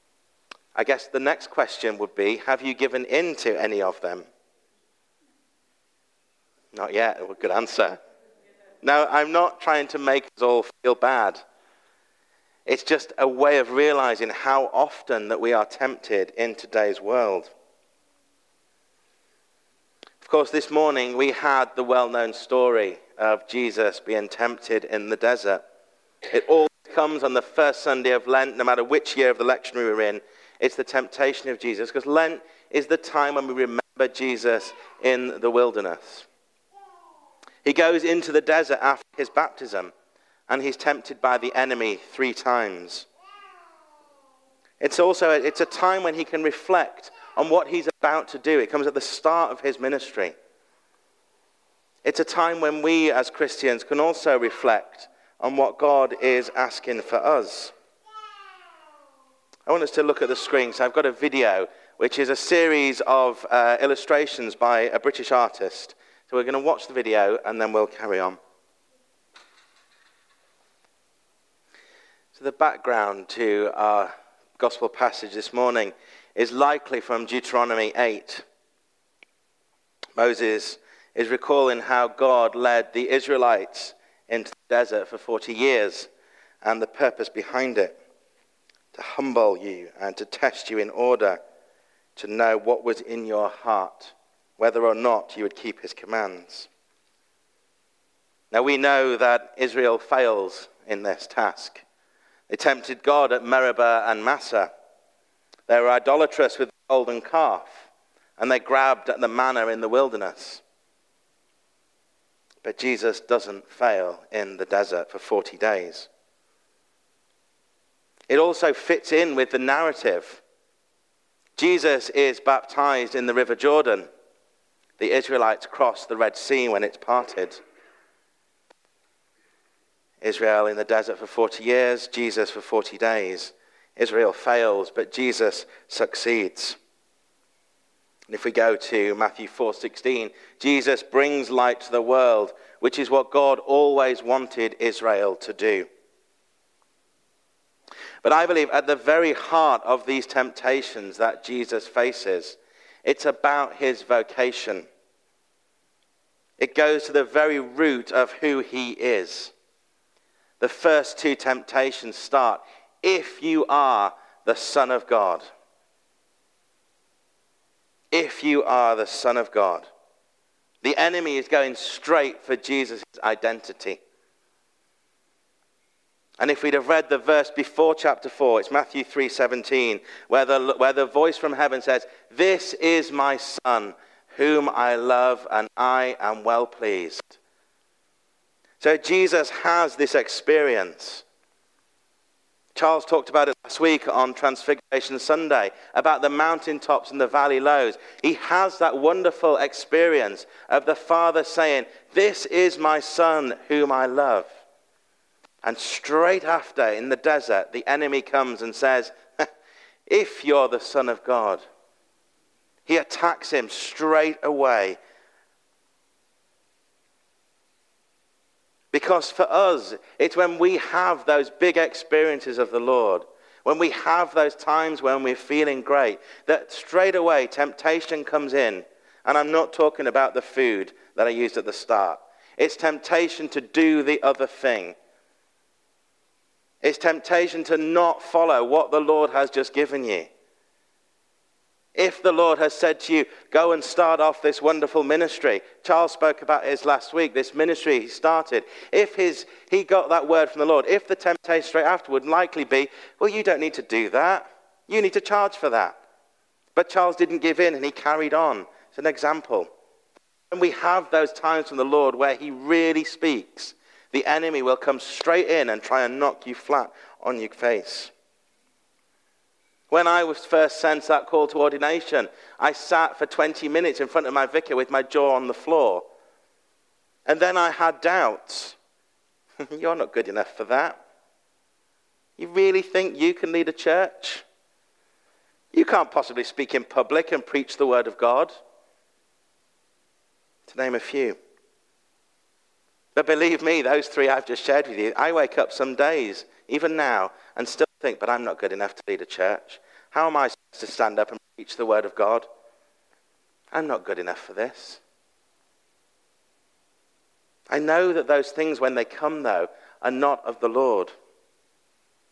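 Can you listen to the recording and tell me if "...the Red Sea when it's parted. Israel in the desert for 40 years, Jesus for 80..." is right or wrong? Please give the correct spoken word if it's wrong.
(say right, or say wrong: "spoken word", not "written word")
wrong: "40", not "80".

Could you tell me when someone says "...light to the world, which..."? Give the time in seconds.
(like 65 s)
141 s.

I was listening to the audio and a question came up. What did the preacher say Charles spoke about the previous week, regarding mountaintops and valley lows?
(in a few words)
Transfiguration Sunday.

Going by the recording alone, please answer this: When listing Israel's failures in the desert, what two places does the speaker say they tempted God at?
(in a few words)
Meribah and Massah.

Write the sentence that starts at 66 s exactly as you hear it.
So we're going to watch the video and then we'll carry on.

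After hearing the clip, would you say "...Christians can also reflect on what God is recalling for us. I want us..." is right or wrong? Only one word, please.
wrong.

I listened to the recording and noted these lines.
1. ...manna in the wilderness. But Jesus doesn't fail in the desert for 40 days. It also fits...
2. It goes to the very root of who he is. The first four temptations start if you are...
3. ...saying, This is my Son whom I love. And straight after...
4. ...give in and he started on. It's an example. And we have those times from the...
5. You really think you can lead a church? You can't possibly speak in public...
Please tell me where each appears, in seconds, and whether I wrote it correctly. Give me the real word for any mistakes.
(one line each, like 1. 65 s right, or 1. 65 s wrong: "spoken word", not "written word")
1. 109 s right
2. 156 s wrong: "two", not "four"
3. 201 s right
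4. 257 s wrong: "carried", not "started"
5. 282 s right.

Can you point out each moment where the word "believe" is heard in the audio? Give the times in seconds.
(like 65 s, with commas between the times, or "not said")
148 s, 293 s.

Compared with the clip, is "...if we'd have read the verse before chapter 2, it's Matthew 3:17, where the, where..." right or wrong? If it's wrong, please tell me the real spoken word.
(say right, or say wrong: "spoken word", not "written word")
wrong: "4", not "2".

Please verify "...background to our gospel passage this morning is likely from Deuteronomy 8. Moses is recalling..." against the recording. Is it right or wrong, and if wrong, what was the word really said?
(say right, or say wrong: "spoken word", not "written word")
right.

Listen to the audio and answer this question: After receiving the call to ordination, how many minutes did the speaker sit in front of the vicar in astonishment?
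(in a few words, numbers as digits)
20.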